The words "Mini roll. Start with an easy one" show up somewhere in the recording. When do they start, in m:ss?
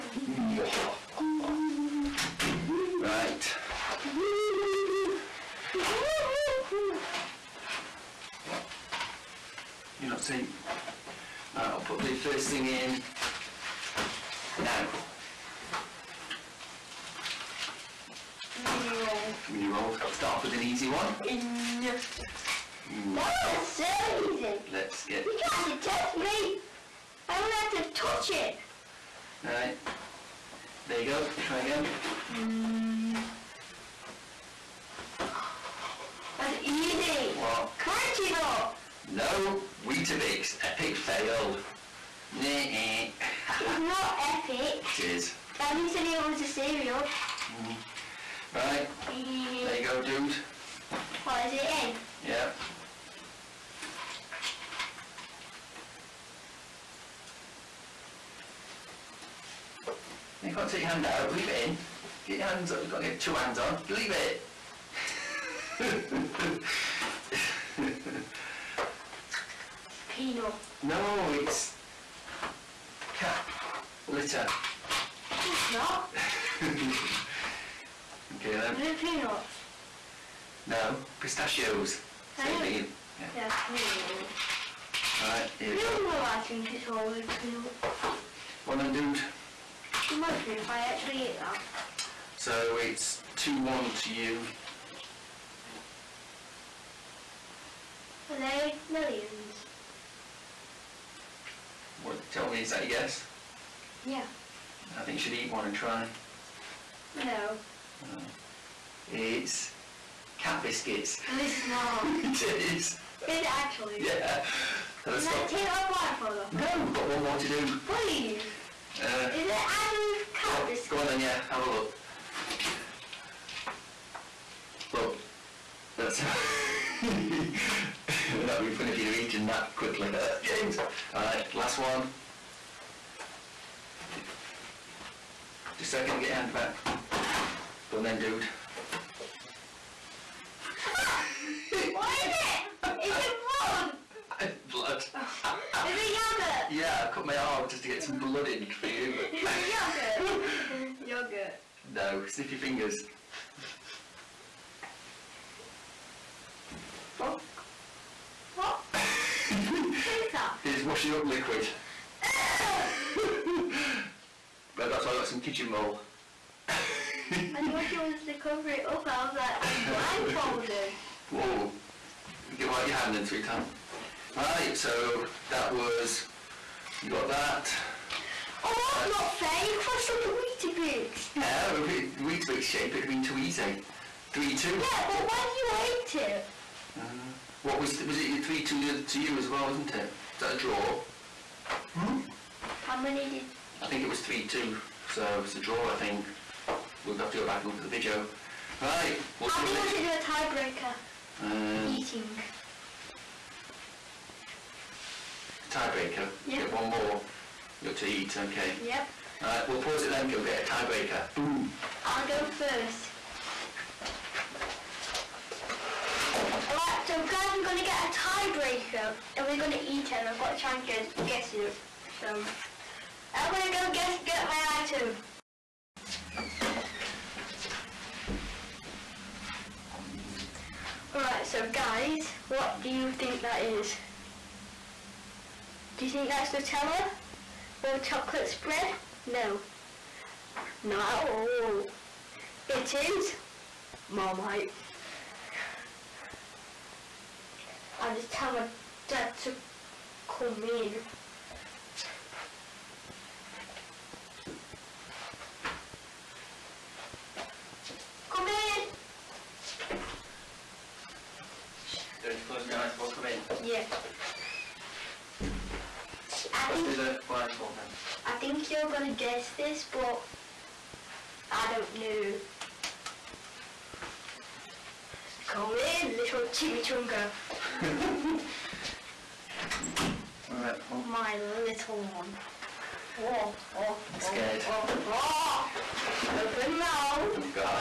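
0:19.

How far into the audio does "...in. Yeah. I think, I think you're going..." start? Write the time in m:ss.
4:23.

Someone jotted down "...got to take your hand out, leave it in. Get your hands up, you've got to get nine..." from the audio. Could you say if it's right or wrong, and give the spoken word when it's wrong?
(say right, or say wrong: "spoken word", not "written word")
wrong: "two", not "nine".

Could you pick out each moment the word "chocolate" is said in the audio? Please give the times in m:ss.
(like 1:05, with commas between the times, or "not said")
3:57.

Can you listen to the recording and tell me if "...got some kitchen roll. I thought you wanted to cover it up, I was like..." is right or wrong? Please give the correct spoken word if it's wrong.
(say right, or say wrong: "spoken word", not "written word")
right.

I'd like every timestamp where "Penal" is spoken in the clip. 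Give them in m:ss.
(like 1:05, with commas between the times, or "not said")
1:10.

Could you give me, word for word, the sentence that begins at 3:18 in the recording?
Right, we'll I think we should do a tiebreaker.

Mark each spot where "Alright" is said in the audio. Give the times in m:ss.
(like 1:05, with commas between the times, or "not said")
0:29, 1:25, 2:11, 3:29, 3:36, 3:51.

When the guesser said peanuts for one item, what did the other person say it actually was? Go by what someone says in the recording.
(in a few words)
Pistachios.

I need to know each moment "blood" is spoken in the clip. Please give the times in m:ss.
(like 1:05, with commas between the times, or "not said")
2:28.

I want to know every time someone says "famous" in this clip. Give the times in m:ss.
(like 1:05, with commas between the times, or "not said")
not said.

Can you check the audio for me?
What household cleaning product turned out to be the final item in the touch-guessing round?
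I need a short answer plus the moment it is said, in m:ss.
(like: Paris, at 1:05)
Washing up liquid, at 2:40.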